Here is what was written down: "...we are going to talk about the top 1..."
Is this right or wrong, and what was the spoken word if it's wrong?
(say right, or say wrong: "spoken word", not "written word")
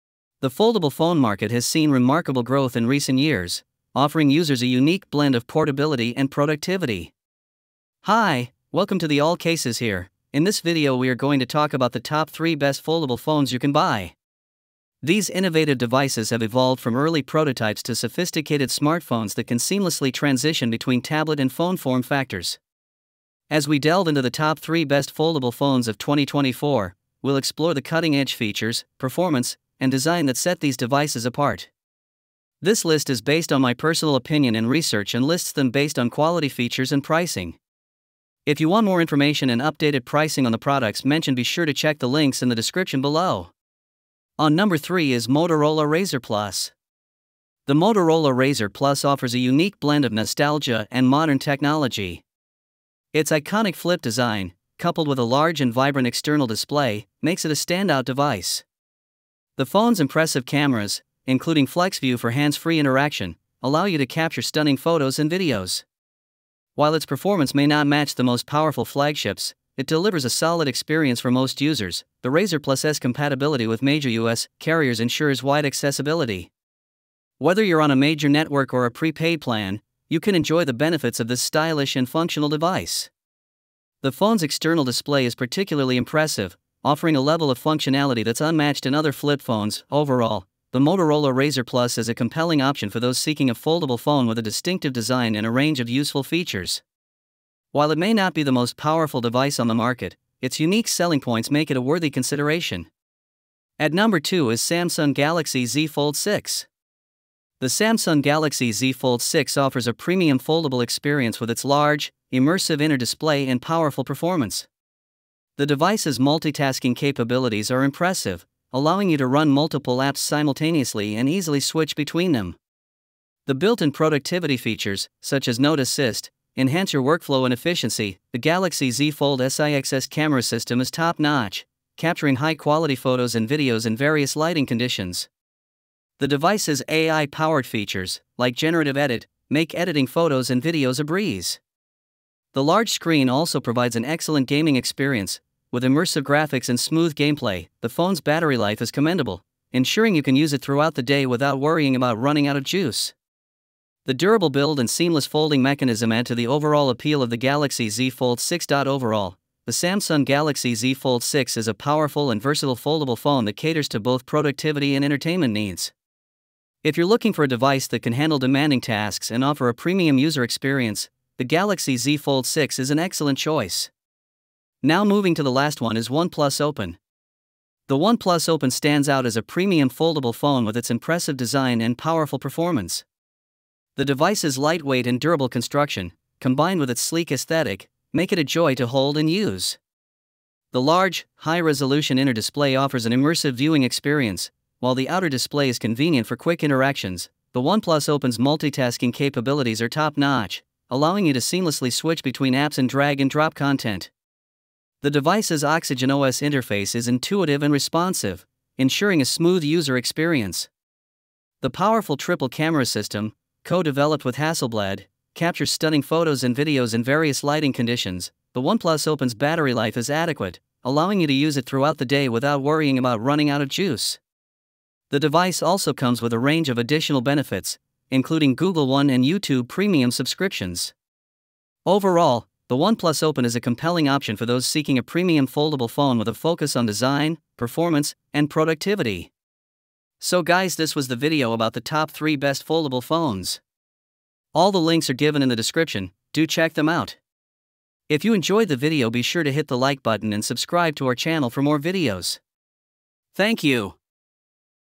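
wrong: "3", not "1".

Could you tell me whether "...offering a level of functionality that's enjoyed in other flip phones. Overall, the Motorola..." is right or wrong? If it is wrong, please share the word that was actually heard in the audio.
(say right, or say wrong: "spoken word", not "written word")
wrong: "unmatched", not "enjoyed".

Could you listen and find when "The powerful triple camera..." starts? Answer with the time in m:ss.
3:31.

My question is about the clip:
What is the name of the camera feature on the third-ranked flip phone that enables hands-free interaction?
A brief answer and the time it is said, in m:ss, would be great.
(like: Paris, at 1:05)
FlexView, at 1:01.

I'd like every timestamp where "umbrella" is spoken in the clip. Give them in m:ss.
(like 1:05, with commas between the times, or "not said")
not said.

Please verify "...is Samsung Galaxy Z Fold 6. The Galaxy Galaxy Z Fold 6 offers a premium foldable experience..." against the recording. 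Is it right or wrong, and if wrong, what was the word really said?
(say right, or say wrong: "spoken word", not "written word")
wrong: "Samsung", not "Galaxy".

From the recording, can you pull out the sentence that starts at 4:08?
If you enjoyed the video be sure to hit the like button and subscribe to our channel for more videos.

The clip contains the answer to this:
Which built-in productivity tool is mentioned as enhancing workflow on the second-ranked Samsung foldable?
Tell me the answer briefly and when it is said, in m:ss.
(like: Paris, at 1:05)
Note Assist, at 2:05.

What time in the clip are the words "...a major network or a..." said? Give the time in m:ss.
1:17.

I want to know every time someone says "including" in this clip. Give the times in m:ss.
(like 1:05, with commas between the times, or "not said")
1:01, 3:48.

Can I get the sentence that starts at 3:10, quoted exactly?
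The large, high-resolution inner display offers an immersive viewing experience, while the outer display is convenient for quick interactions.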